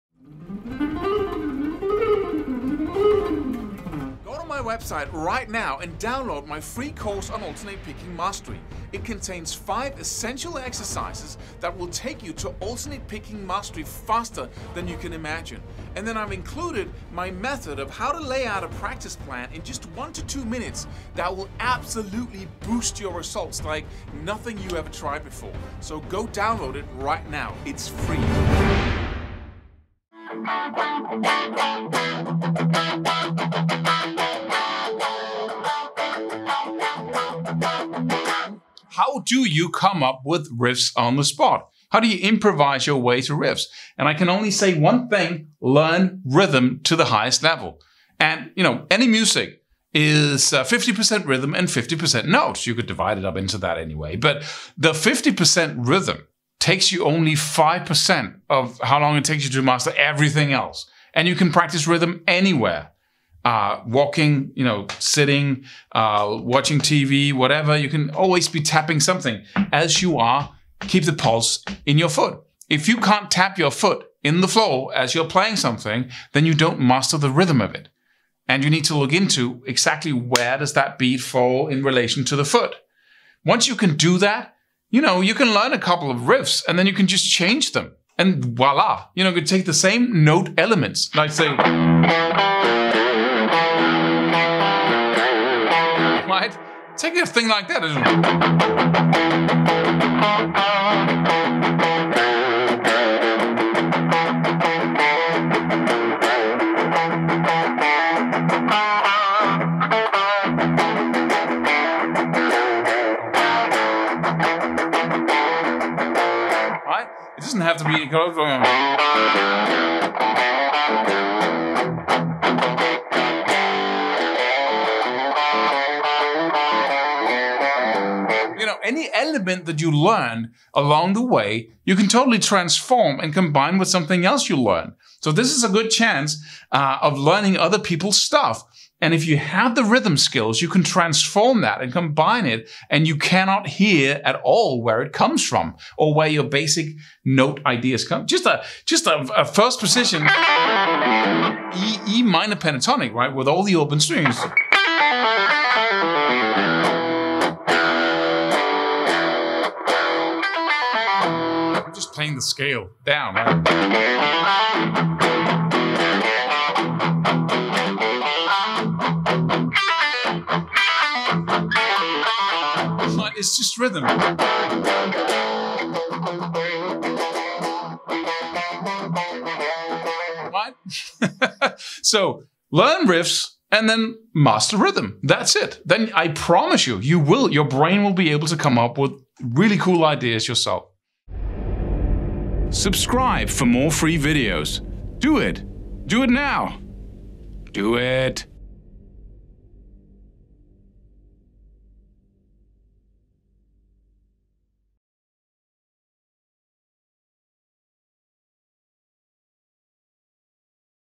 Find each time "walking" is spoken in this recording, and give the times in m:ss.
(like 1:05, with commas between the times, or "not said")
1:03.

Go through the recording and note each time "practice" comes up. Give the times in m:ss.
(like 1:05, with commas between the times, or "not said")
0:18, 1:01.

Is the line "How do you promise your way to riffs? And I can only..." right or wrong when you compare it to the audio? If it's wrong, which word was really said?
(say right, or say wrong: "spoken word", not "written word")
wrong: "improvise", not "promise".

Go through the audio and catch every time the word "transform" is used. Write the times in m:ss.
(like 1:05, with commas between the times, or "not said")
2:12, 2:20.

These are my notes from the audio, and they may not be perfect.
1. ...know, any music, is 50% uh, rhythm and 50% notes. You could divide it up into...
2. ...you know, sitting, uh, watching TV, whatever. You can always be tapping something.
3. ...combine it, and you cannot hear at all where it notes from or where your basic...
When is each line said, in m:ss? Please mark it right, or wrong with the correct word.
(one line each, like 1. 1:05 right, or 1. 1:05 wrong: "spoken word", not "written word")
1. 0:48 right
2. 1:04 right
3. 2:21 wrong: "comes", not "notes".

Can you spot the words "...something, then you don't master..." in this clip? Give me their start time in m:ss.
1:15.